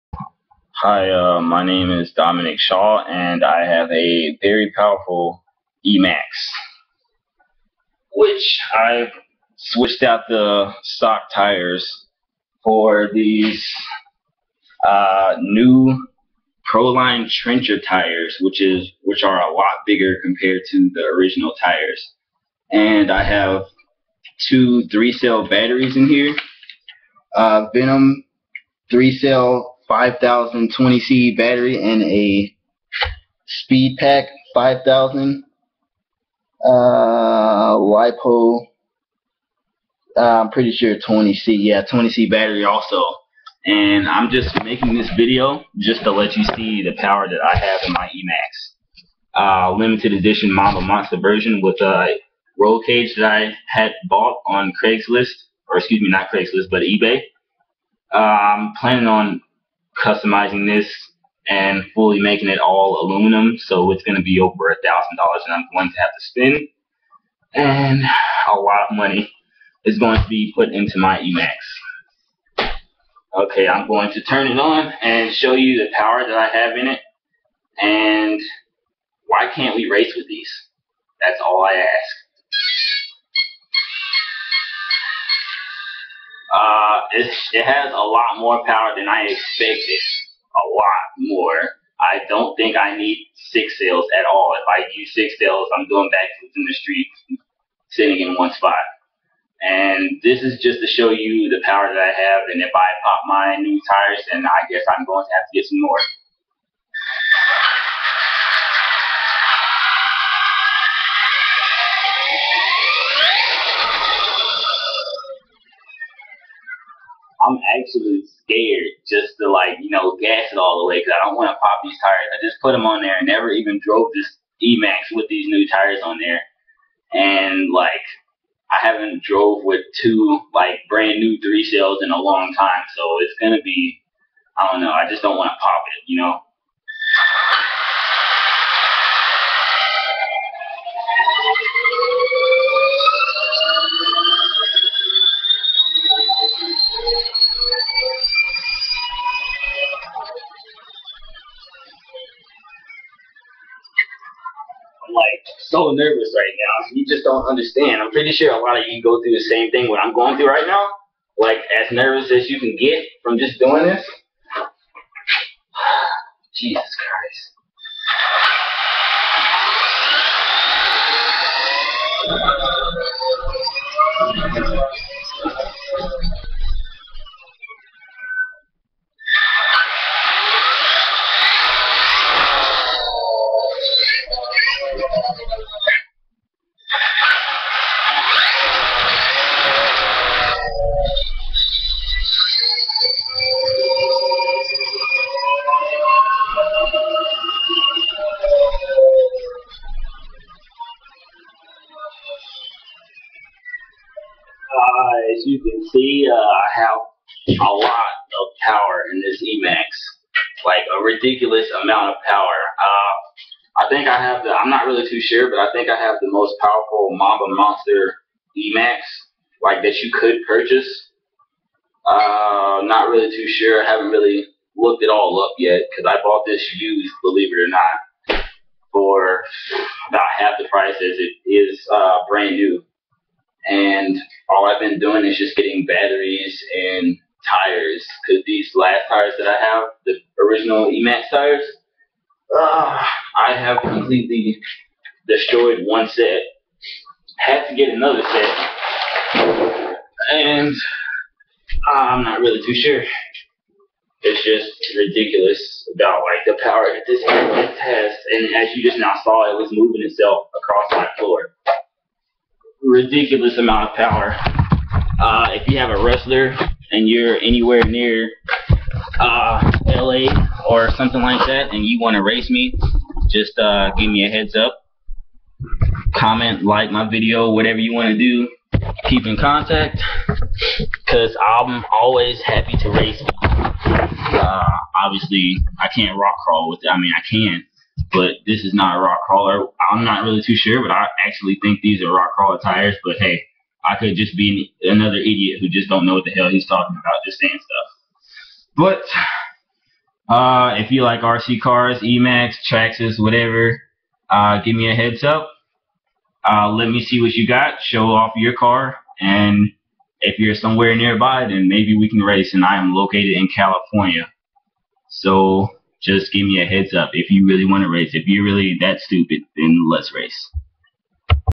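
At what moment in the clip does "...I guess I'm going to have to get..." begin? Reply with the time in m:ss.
1:44.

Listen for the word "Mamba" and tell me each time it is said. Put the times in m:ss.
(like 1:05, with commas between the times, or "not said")
0:50, 3:37.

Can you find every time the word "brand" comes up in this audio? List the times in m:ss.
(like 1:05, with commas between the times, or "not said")
2:10, 3:52.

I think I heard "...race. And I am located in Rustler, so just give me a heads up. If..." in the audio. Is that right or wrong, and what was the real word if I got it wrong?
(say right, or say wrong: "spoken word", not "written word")
wrong: "California", not "Rustler".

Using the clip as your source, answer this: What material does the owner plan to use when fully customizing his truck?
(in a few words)
aluminum.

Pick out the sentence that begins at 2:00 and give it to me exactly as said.
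gas it all the way because I don't want to pop these tires.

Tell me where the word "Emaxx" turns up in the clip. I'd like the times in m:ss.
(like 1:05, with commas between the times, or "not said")
0:05, 0:48, 1:11, 2:04, 3:29, 3:38, 4:00, 5:01.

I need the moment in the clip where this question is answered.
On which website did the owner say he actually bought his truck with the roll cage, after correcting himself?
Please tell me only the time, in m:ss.
0:56.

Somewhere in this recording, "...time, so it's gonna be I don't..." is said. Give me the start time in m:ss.
2:12.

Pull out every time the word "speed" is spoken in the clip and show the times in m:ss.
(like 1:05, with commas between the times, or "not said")
0:33.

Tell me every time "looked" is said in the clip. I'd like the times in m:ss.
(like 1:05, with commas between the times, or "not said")
3:44.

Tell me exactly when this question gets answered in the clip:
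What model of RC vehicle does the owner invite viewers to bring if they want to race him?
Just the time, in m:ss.
4:26.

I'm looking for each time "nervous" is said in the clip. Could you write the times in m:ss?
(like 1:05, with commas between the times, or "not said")
2:35, 2:41.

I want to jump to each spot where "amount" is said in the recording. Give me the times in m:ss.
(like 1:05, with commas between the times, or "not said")
3:31, 4:23.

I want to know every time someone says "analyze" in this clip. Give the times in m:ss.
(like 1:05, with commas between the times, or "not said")
not said.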